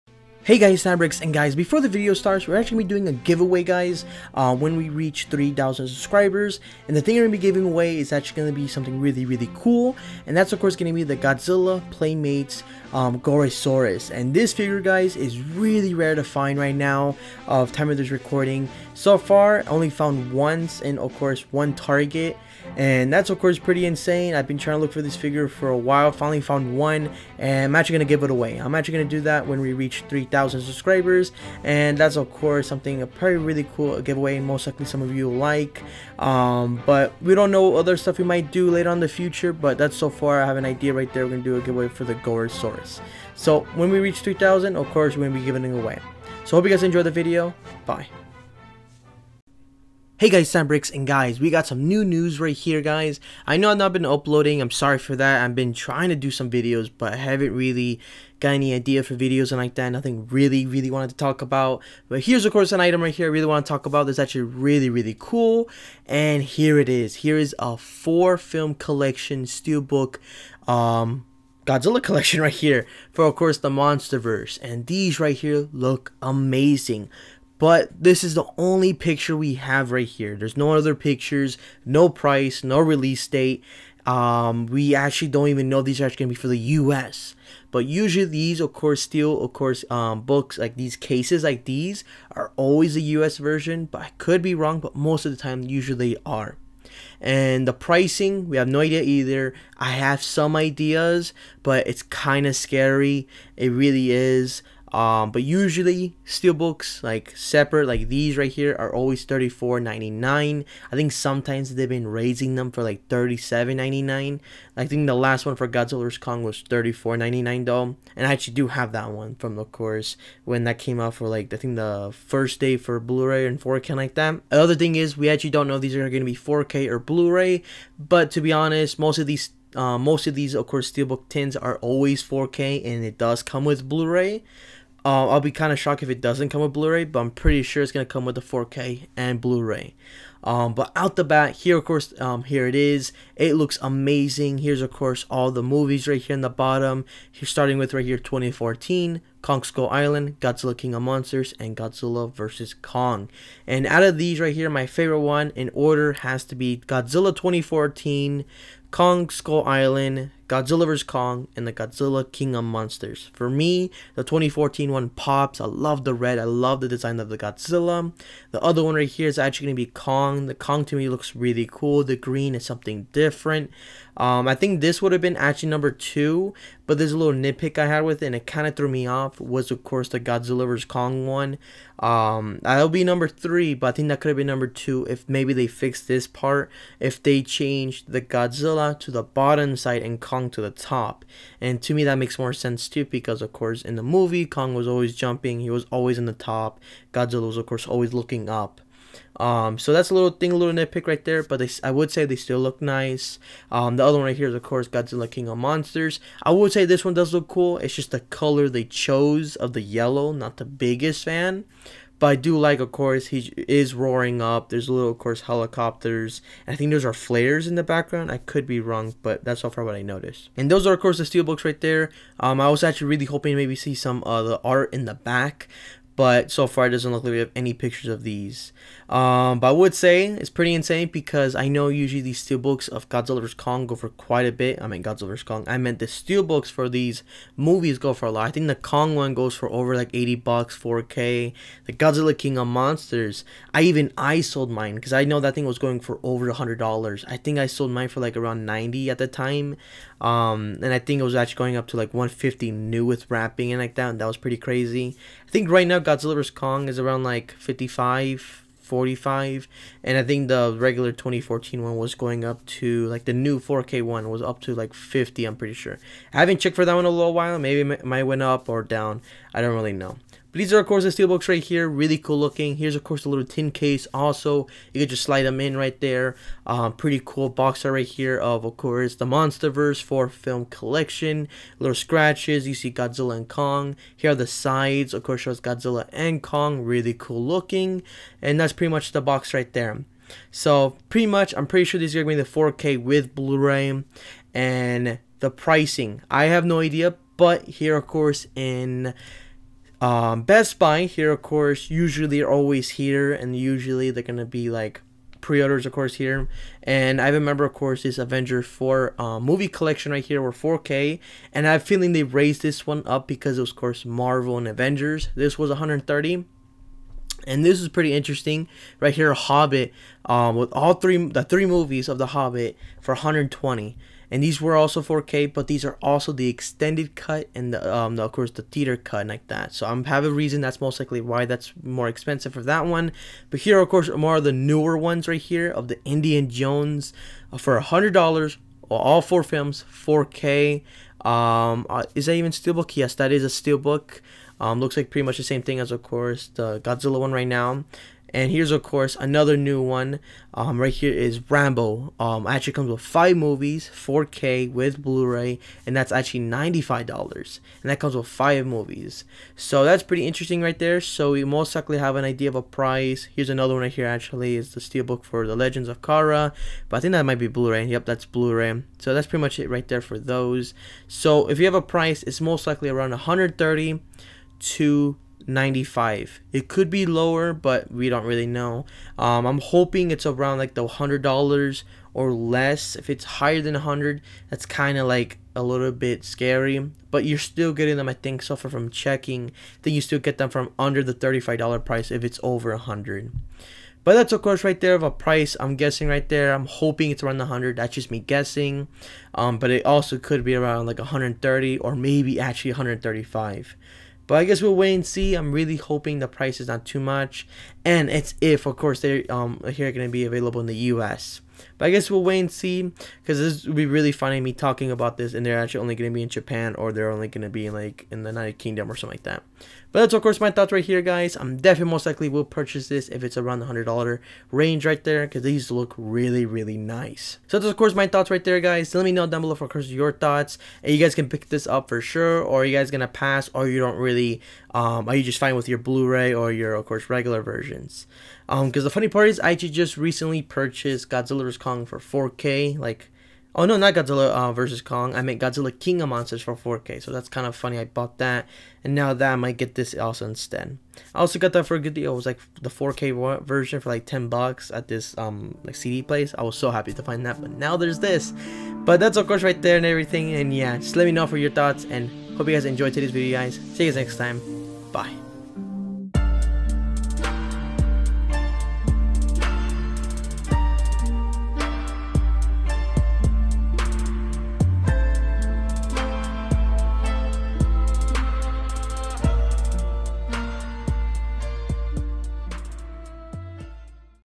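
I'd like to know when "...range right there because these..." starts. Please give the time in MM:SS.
07:04.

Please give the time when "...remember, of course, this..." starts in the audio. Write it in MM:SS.
05:07.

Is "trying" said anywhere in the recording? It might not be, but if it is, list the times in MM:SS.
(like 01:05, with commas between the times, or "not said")
00:24, 00:55.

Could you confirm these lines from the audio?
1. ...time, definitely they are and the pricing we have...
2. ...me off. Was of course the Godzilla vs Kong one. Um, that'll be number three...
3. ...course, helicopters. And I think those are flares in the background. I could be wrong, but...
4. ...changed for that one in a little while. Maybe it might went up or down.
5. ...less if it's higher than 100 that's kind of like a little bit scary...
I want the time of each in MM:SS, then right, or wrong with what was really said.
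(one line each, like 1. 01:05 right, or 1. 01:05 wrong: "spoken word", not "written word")
1. 01:35 wrong: "usually", not "definitely"
2. 02:58 right
3. 03:35 right
4. 04:26 wrong: "checked", not "changed"
5. 06:22 right.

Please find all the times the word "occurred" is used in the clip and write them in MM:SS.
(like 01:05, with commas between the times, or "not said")
not said.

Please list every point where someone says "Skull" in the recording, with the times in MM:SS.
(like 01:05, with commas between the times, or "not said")
02:29, 02:39.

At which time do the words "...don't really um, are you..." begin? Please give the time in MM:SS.
07:13.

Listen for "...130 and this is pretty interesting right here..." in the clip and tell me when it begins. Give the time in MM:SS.
05:15.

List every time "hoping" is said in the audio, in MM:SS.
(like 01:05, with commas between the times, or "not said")
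03:43, 06:19, 06:36, 06:45.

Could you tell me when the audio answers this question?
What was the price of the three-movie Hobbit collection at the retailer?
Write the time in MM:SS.
05:23.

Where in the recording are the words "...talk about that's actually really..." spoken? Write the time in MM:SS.
01:03.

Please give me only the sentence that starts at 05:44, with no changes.
Um, looks like pretty much the same thing as, of course, the Godzilla one right now.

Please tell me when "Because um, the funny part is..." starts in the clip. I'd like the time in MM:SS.
07:18.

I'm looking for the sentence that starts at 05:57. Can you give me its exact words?
And that comes with five movies.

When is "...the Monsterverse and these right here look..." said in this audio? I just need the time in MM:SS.
01:13.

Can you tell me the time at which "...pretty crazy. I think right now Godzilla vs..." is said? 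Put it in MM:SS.
04:14.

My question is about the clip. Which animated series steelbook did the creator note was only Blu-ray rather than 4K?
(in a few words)
The Legends of Korra.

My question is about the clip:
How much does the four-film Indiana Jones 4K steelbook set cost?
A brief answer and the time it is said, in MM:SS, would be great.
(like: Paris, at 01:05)
$100, at 05:37.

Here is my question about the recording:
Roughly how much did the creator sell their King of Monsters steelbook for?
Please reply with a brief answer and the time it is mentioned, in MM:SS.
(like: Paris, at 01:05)
around 90, at 04:08.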